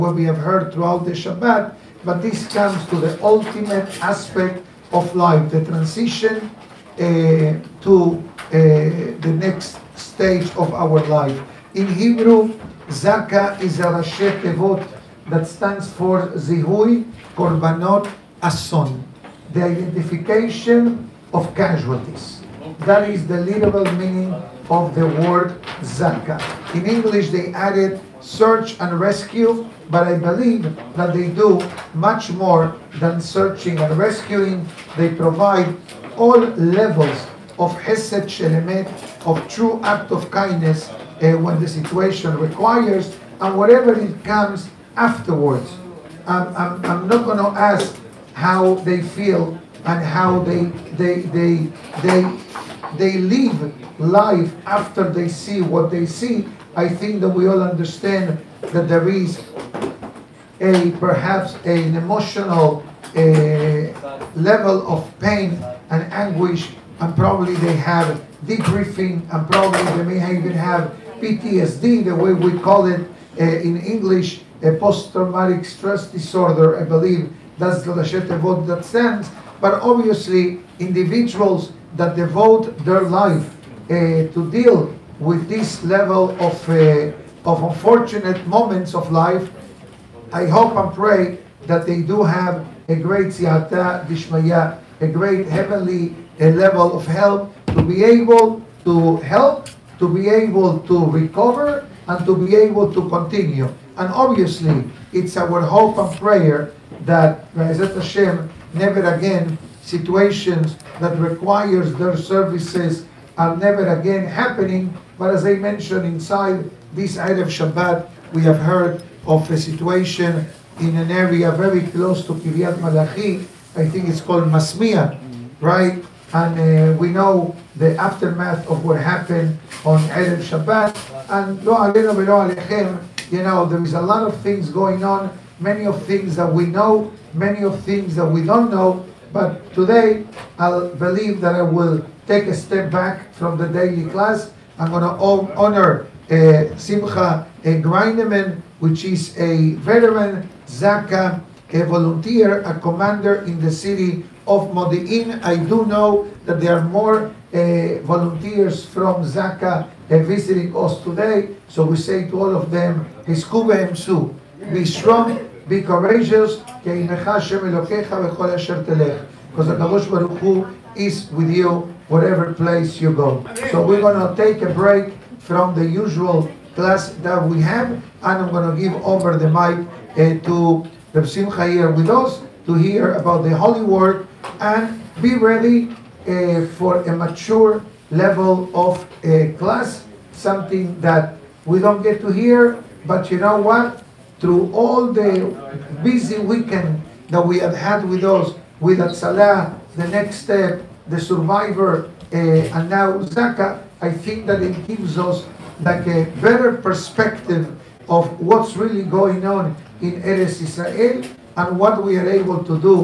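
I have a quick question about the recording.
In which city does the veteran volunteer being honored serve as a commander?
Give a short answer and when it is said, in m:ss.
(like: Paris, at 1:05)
Modi'in, at 2:34.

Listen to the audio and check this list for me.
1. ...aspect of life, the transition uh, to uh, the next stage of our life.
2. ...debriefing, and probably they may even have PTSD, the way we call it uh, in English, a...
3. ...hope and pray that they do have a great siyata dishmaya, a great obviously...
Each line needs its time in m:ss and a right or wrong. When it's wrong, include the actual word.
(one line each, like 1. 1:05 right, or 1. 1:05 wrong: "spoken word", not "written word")
1. 0:04 right
2. 1:08 right
3. 1:30 wrong: "heavenly", not "obviously".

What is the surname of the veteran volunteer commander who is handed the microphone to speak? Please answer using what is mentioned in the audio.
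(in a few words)
Greineman.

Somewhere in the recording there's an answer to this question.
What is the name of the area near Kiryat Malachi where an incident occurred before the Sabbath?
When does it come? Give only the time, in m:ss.
2:04.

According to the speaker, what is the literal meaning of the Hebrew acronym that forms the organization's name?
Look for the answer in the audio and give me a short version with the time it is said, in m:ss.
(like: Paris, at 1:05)
Identification of casualties, at 0:19.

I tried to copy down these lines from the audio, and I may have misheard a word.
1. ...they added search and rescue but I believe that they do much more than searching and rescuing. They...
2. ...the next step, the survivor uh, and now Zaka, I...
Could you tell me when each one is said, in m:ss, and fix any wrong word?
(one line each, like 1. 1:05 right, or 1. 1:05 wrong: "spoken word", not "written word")
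1. 0:27 right
2. 3:19 right.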